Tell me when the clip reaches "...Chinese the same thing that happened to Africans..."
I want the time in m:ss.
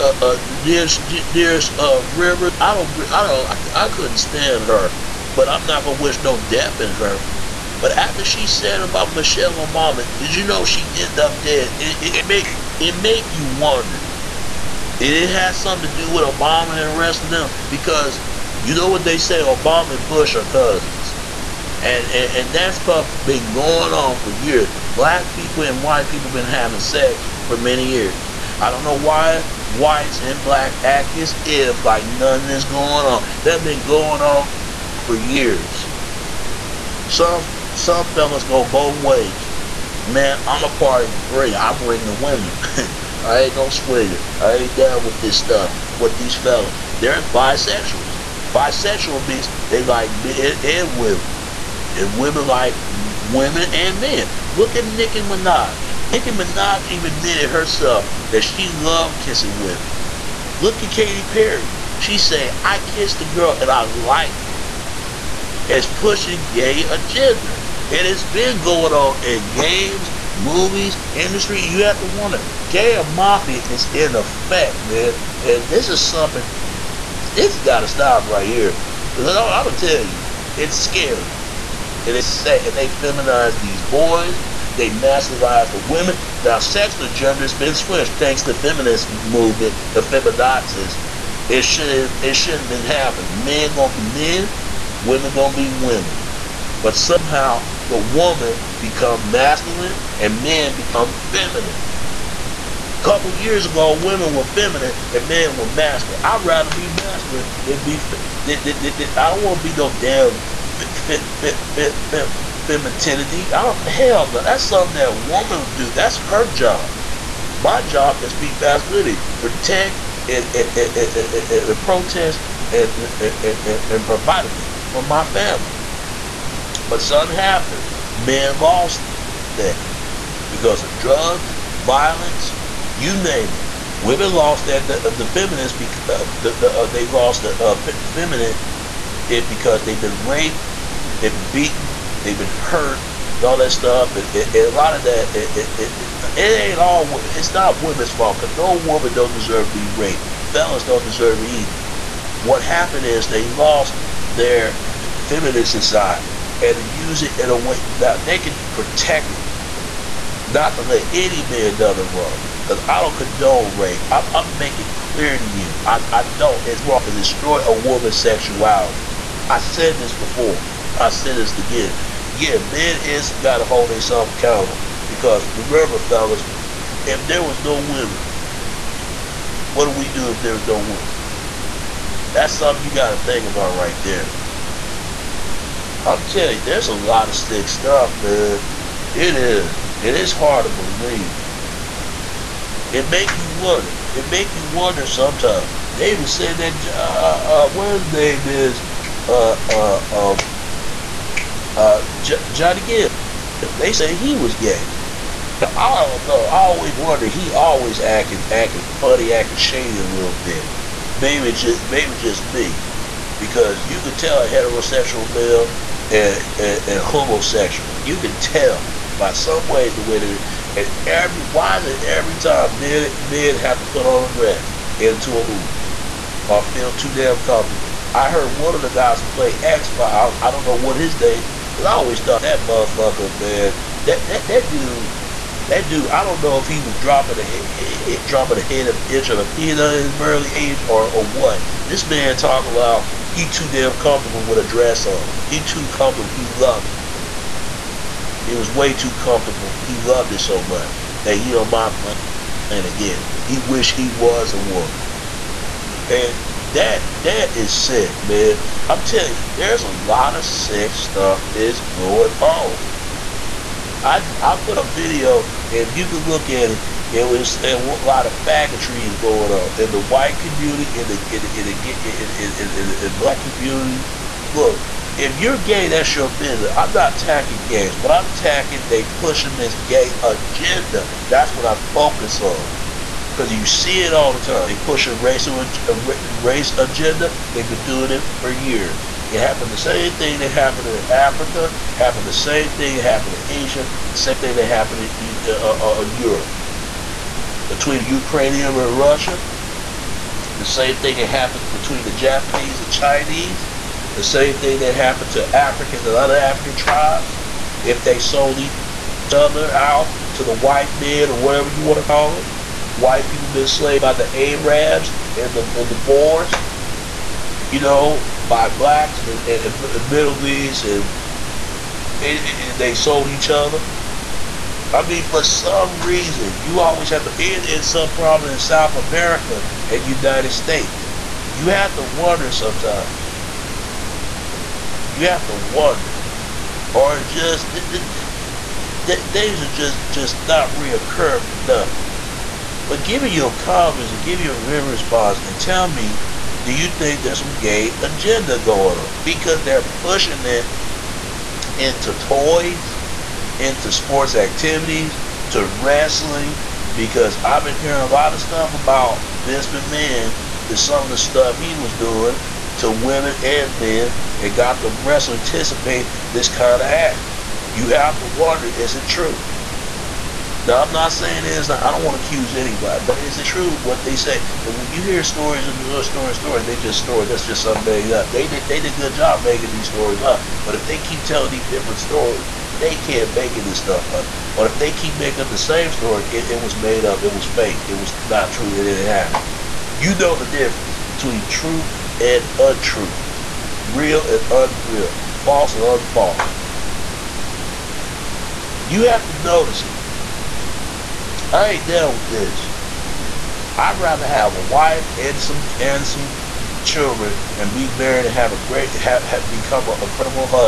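5:02.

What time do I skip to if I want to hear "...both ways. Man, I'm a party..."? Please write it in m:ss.
0:38.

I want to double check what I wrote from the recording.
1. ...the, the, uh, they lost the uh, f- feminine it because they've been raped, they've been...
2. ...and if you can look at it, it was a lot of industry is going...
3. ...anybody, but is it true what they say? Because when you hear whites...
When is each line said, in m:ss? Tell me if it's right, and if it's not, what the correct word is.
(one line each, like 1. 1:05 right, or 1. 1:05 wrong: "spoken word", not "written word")
1. 2:16 right
2. 4:25 wrong: "faggotry", not "industry"
3. 6:12 wrong: "stories", not "whites".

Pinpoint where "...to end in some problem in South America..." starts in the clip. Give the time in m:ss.
5:27.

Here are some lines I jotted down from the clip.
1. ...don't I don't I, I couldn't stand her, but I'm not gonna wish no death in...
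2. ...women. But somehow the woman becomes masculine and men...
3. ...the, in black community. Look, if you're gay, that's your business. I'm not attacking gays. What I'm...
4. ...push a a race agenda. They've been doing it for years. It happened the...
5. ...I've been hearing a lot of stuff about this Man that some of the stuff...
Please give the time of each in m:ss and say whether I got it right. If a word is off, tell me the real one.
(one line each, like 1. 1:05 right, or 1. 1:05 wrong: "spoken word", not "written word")
1. 0:02 right
2. 1:35 right
3. 4:32 right
4. 4:44 right
5. 5:57 right.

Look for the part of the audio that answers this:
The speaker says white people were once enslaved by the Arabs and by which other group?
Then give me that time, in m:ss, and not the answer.
5:15.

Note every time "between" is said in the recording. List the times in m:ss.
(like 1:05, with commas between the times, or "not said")
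4:57, 5:01, 6:31.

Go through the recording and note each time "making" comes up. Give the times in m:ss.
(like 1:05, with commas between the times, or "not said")
2:44, 6:19, 6:25.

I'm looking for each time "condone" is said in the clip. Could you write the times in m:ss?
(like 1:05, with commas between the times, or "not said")
2:43.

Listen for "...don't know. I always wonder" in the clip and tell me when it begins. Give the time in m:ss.
3:26.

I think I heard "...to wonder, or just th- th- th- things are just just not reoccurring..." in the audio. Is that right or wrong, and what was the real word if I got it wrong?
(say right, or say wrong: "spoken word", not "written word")
right.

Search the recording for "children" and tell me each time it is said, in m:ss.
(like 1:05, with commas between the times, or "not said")
6:46.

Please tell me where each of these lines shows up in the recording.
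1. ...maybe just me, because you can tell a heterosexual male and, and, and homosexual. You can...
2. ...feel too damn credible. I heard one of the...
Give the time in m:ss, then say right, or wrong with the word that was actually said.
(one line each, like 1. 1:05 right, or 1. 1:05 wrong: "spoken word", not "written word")
1. 3:31 right
2. 3:46 wrong: "comfortable", not "credible".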